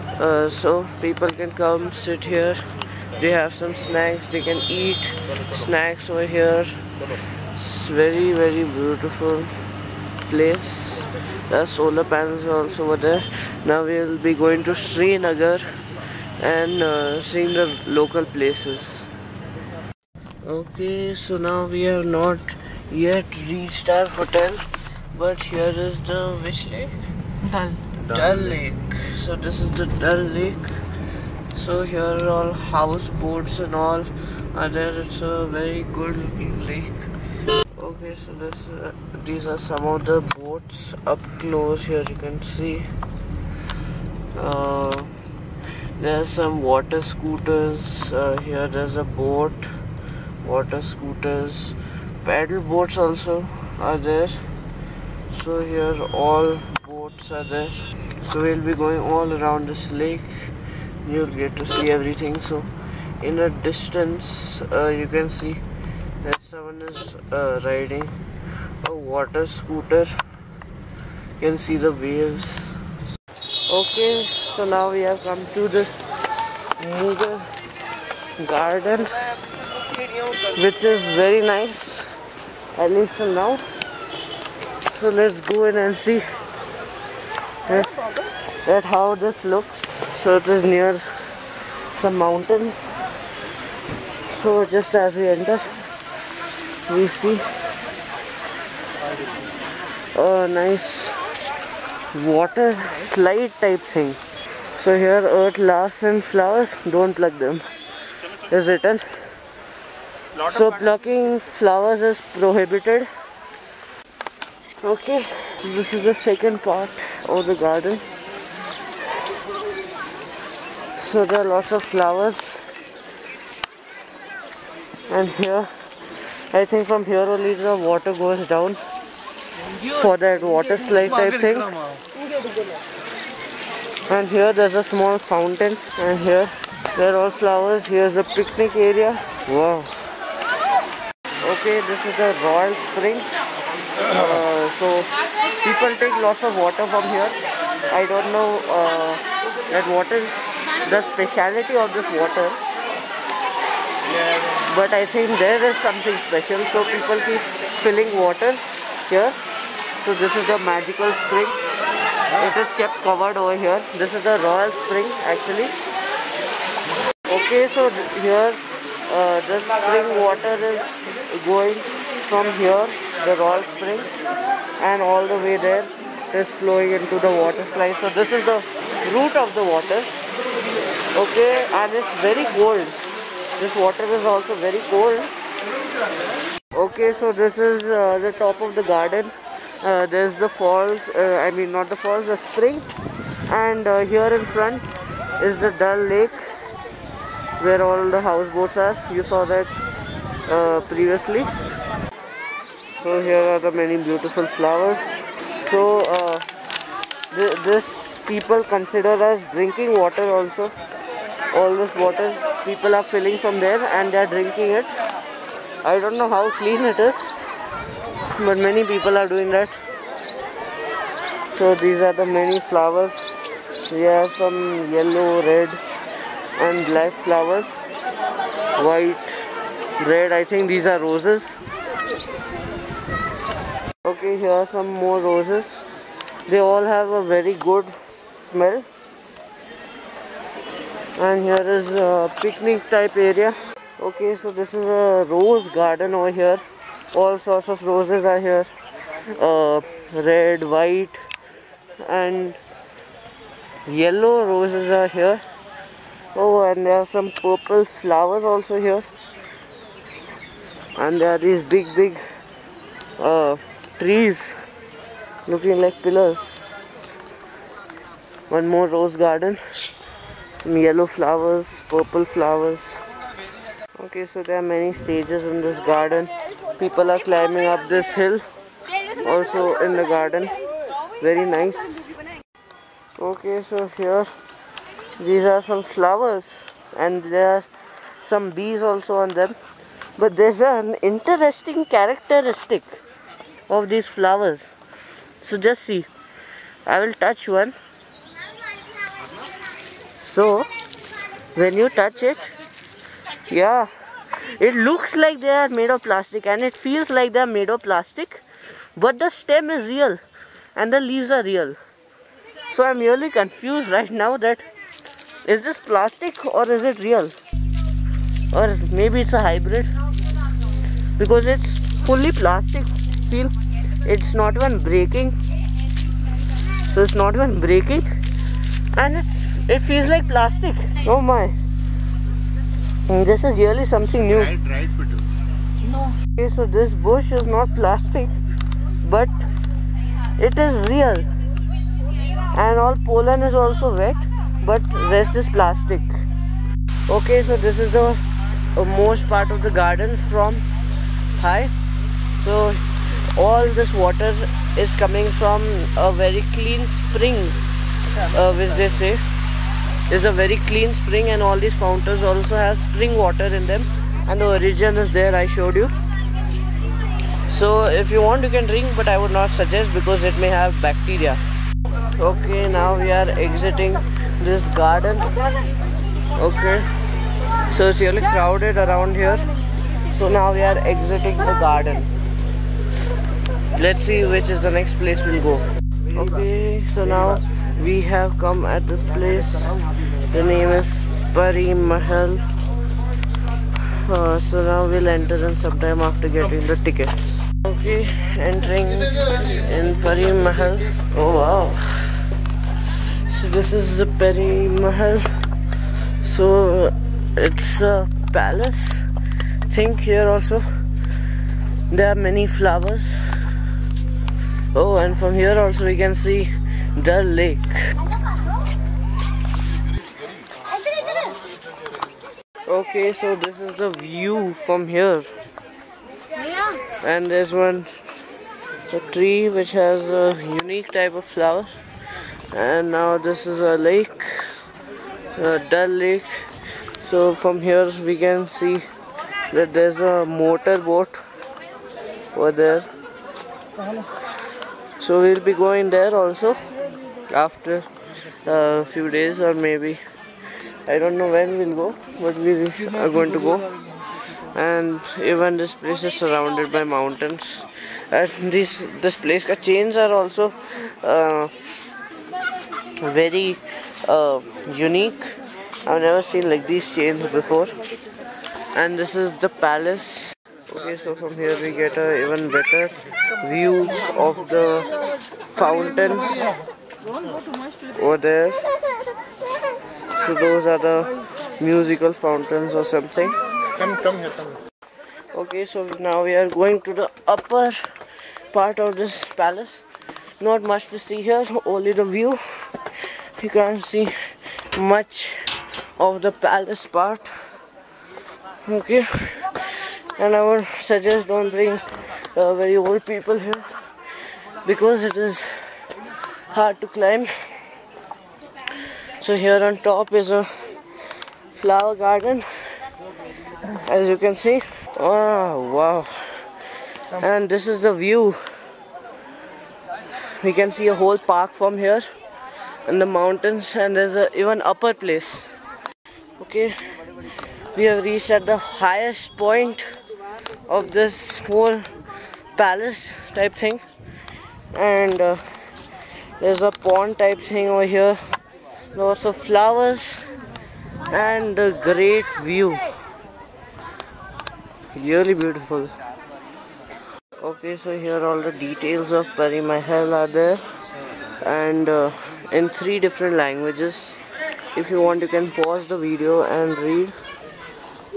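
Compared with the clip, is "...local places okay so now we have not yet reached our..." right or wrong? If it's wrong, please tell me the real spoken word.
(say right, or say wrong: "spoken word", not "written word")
right.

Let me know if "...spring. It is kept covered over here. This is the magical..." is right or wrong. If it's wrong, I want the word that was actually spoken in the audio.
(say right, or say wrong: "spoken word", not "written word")
wrong: "royal", not "magical".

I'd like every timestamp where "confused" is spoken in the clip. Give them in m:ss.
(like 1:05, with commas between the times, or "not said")
5:13.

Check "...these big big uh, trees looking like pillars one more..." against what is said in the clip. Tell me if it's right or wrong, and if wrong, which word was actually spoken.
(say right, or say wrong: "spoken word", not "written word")
right.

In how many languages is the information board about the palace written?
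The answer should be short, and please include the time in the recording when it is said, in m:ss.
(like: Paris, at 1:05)
3, at 9:12.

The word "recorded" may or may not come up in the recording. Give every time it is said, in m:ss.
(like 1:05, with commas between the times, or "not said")
not said.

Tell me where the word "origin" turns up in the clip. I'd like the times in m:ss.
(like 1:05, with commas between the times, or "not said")
6:04.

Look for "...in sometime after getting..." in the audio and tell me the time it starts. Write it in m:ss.
6:35.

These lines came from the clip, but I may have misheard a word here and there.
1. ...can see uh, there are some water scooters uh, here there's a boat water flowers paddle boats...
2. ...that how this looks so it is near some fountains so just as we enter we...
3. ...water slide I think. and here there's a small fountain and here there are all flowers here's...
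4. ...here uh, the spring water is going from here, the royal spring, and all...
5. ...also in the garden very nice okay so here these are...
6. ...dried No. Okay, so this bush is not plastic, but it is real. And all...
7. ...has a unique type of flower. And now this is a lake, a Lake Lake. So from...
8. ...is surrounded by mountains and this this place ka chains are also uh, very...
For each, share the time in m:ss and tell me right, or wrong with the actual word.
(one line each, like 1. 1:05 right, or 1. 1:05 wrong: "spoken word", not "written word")
1. 0:42 wrong: "scooters", not "flowers"
2. 1:28 wrong: "mountains", not "fountains"
3. 2:10 right
4. 2:48 right
5. 4:39 right
6. 5:34 right
7. 7:09 wrong: "Dal", not "Lake"
8. 7:36 right.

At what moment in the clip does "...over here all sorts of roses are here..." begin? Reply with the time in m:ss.
4:06.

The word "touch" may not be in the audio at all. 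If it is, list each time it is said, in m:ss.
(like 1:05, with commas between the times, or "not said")
4:57, 5:01.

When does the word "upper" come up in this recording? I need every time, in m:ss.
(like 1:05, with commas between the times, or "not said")
8:07, 8:44.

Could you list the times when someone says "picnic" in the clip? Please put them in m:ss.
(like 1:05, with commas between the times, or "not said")
2:18, 4:02.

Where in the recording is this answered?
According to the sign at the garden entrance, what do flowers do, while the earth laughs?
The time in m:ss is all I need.
1:46.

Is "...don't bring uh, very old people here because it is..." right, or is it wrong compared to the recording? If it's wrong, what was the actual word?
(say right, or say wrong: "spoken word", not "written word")
right.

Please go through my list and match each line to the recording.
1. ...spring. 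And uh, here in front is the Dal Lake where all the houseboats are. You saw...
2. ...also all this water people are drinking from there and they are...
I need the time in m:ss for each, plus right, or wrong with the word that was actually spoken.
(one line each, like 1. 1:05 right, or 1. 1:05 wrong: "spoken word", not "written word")
1. 3:12 right
2. 3:30 wrong: "filling", not "drinking".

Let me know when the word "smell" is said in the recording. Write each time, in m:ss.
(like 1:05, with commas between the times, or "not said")
3:58.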